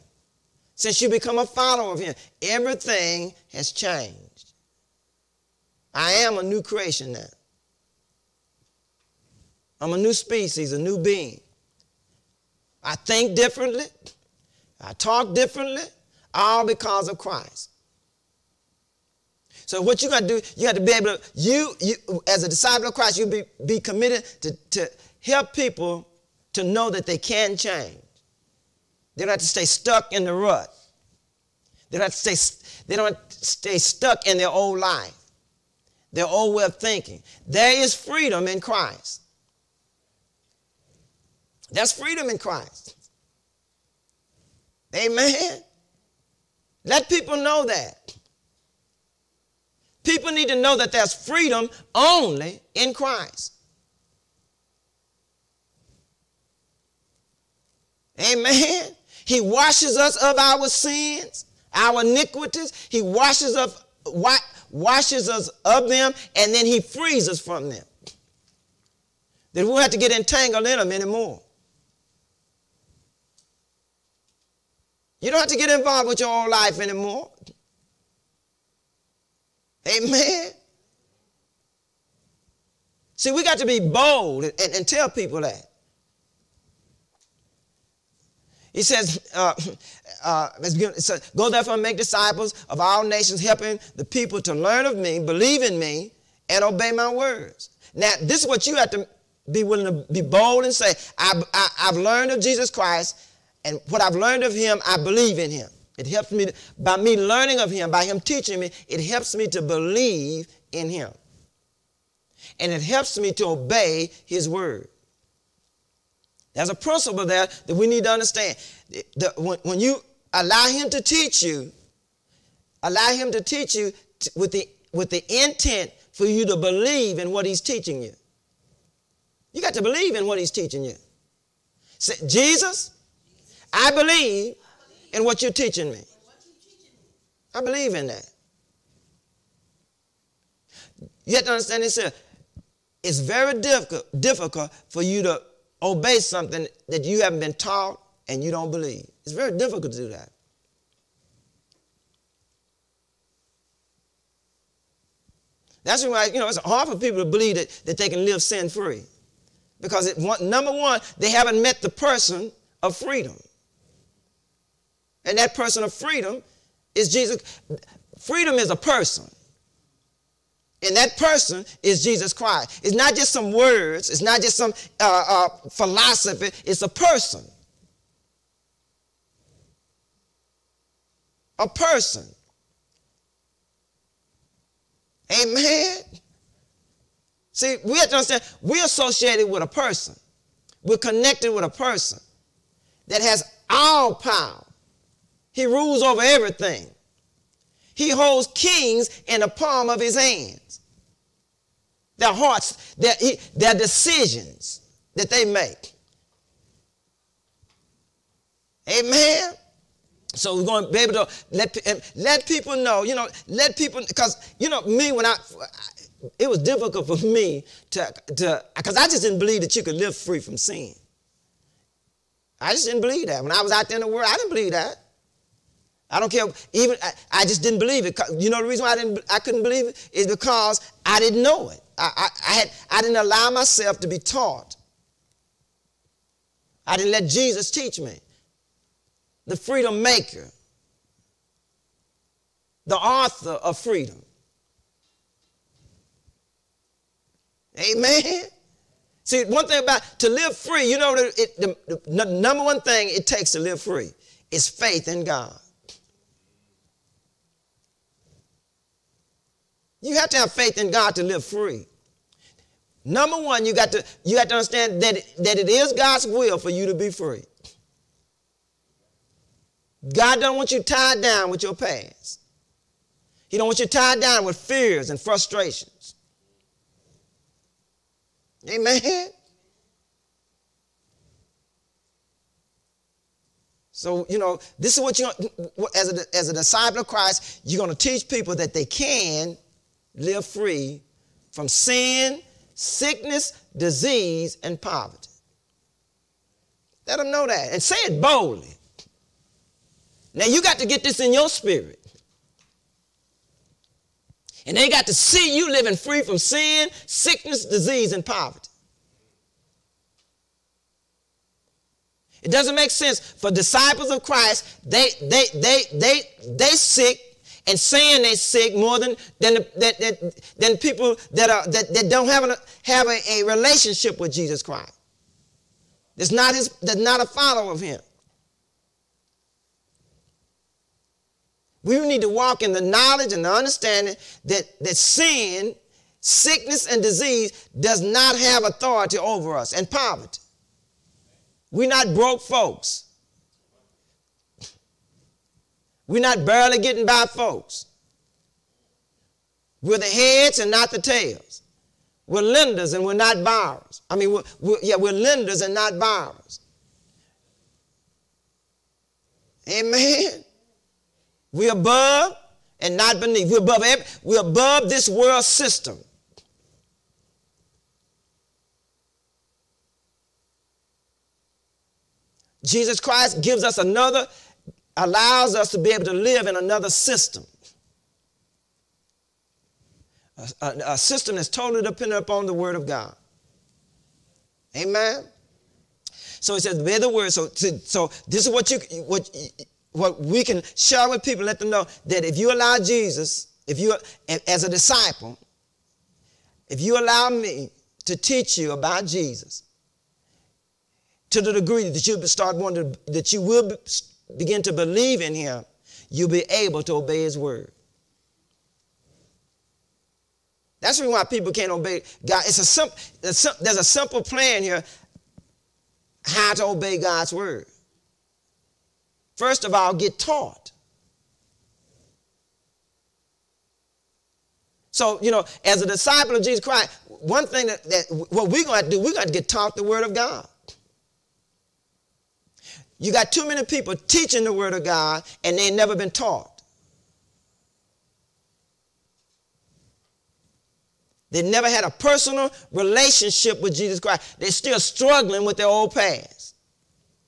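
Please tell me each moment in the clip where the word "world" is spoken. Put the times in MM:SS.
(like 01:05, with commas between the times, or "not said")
03:44, 06:05.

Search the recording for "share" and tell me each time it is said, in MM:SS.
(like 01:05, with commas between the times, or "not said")
06:30.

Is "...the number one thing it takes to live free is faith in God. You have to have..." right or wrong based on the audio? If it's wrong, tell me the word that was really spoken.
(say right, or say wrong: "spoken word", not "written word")
right.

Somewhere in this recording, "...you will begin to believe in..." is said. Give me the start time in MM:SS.
06:43.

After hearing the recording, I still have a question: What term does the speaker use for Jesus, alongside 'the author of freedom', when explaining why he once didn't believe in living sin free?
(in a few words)
The freedom maker.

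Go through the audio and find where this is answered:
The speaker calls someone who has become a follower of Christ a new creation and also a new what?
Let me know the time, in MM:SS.
00:09.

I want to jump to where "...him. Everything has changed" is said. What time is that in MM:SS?
00:01.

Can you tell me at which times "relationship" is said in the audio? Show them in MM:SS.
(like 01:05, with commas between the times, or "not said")
05:23, 07:22.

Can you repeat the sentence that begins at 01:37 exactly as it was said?
Now, this is what you have to be willing to be bold and say I, I, I've learned of Jesus Christ.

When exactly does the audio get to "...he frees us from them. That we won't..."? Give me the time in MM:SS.
01:06.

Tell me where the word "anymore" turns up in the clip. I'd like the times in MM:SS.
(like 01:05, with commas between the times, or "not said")
01:10, 01:16.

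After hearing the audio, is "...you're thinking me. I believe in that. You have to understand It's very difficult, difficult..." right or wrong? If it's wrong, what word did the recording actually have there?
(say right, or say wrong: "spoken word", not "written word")
wrong: "teaching", not "thinking".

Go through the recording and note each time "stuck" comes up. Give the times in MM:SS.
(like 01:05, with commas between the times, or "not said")
00:29, 00:33.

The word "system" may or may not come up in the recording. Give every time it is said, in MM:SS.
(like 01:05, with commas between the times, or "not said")
06:05, 06:16, 06:20.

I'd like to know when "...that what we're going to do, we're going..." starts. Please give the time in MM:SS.
07:07.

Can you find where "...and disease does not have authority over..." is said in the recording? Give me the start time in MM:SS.
05:36.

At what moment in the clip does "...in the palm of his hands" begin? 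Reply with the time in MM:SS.
03:19.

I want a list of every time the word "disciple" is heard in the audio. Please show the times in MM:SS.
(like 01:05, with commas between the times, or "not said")
00:22, 01:31, 04:46, 05:13, 06:34, 07:05.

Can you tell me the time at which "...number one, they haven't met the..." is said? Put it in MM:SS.
02:40.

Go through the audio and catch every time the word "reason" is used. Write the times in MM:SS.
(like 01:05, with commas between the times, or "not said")
03:48, 06:51.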